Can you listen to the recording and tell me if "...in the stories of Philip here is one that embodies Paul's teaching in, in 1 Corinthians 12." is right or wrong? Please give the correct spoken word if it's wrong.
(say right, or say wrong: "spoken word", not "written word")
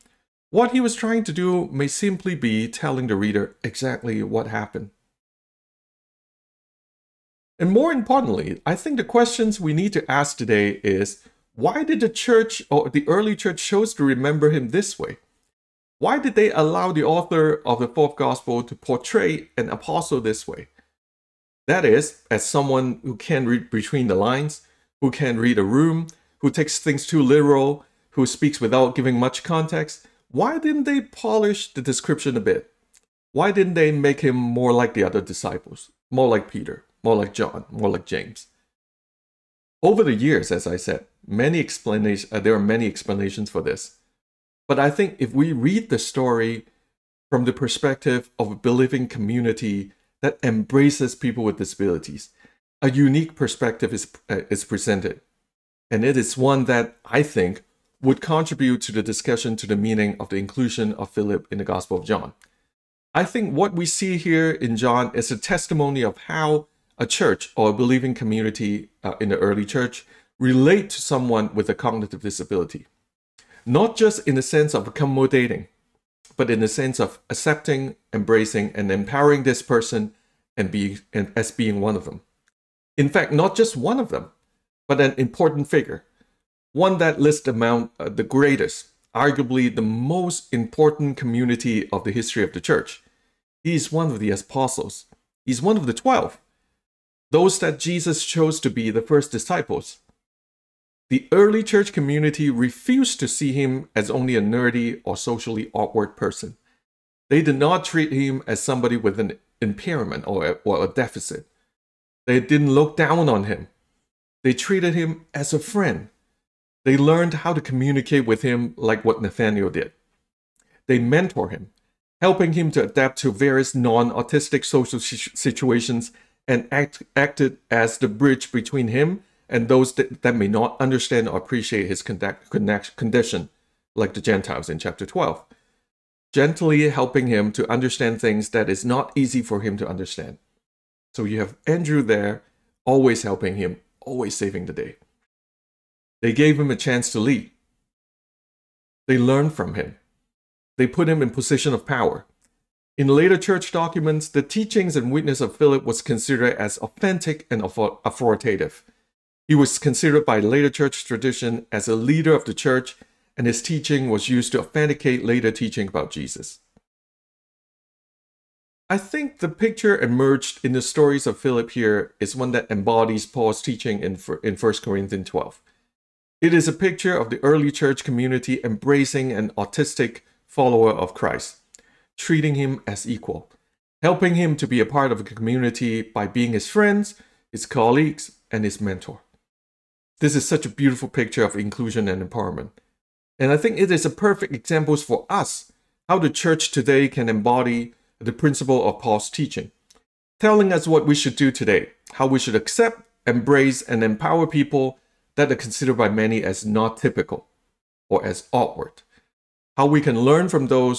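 right.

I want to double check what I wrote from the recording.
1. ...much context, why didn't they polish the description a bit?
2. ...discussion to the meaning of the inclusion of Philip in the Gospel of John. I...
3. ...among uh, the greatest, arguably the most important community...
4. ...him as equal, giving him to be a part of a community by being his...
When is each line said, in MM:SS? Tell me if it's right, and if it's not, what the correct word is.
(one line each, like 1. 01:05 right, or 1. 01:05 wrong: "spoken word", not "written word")
1. 00:29 right
2. 00:59 right
3. 01:27 right
4. 03:02 wrong: "helping", not "giving".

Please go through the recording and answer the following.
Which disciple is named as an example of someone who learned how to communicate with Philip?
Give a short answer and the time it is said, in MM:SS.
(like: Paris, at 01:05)
Nathaniel, at 01:59.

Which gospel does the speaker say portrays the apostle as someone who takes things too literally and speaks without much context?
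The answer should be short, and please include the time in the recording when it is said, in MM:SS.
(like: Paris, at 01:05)
The fourth gospel, at 00:17.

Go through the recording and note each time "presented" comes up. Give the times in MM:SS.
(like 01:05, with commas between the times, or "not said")
00:54.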